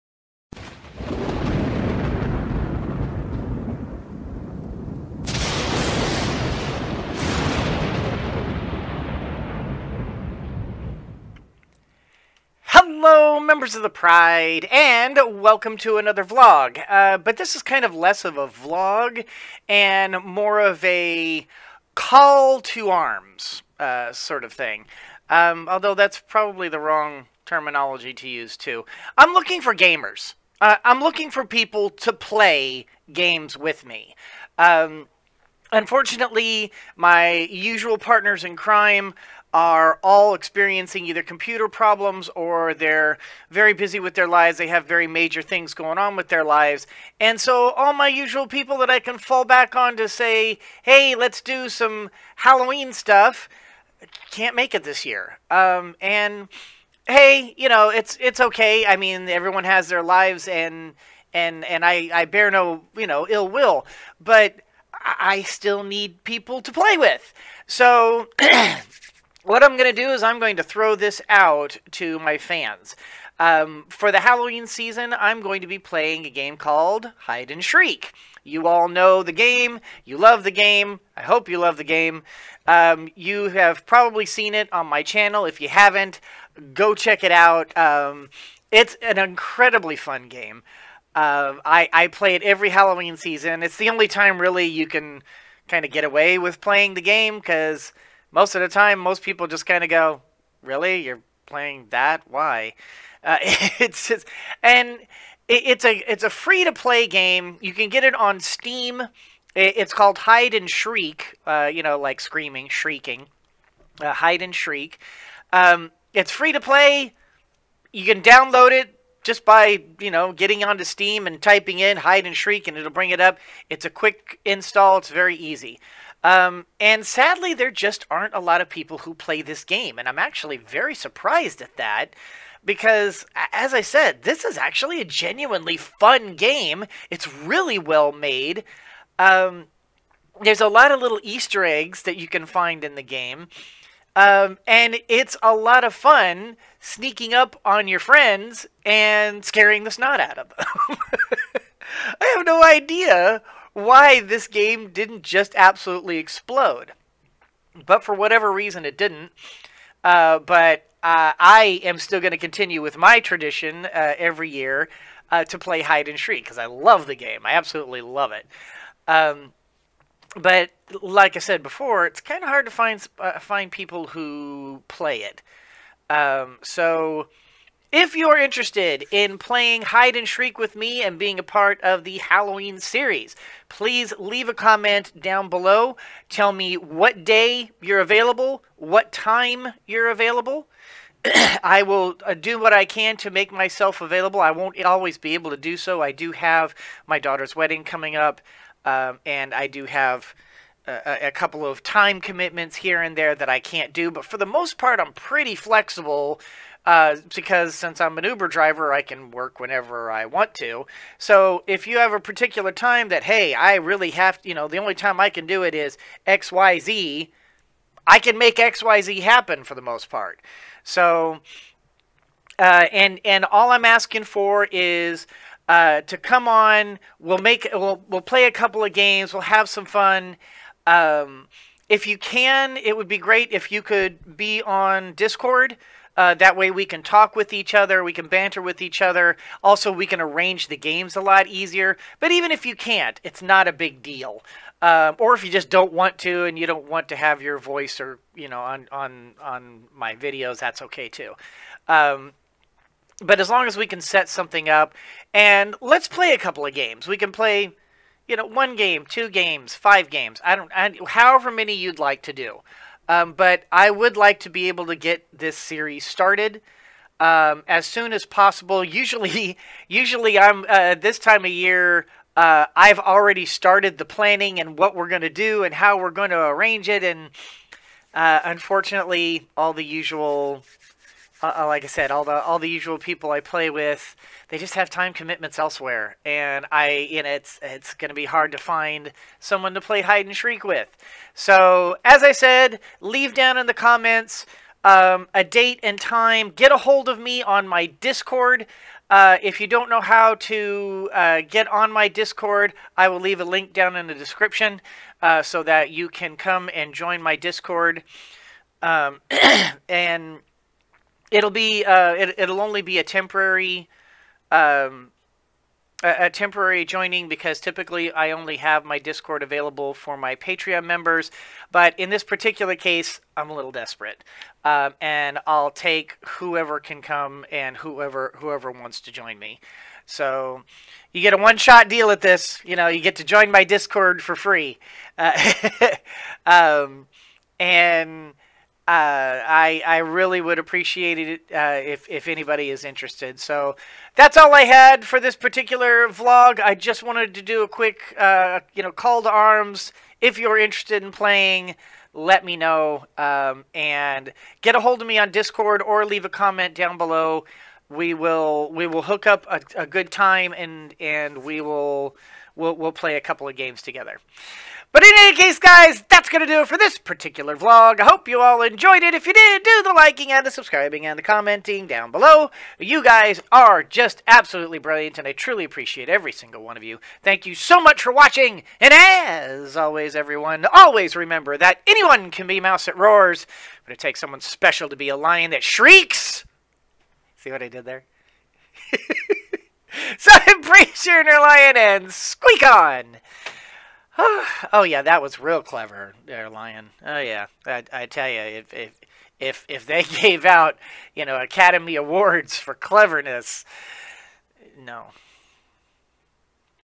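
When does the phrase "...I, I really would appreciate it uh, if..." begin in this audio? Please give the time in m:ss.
5:39.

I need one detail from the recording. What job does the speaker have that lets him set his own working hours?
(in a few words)
Uber driver.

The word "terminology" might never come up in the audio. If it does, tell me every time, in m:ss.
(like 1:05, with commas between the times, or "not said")
0:27.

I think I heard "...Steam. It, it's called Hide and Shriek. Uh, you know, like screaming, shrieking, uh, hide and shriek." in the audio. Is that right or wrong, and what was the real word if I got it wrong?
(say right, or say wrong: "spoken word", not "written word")
right.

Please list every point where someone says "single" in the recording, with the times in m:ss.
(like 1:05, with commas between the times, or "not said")
6:16.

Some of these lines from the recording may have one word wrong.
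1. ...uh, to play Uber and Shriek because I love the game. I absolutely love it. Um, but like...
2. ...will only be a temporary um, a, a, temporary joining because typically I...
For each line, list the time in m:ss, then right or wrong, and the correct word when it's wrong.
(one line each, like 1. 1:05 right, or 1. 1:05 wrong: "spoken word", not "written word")
1. 2:45 wrong: "Hide", not "Uber"
2. 5:12 right.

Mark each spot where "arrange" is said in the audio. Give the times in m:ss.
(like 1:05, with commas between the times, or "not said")
4:00, 4:36.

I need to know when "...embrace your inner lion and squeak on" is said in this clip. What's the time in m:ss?
6:30.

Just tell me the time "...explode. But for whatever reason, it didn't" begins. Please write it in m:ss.
2:36.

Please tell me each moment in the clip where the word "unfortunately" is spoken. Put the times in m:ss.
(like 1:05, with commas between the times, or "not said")
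0:35, 4:38.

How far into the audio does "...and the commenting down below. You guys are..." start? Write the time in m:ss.
6:11.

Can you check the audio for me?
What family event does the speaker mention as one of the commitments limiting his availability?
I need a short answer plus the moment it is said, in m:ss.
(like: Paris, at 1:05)
daughter's wedding, at 3:17.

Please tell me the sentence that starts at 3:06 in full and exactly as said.
Tell me what day you're available, what time you're available.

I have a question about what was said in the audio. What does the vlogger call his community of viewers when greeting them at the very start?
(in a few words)
the Pride.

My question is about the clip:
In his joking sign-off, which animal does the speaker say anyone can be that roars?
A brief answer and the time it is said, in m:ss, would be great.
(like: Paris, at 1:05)
a mouse, at 6:22.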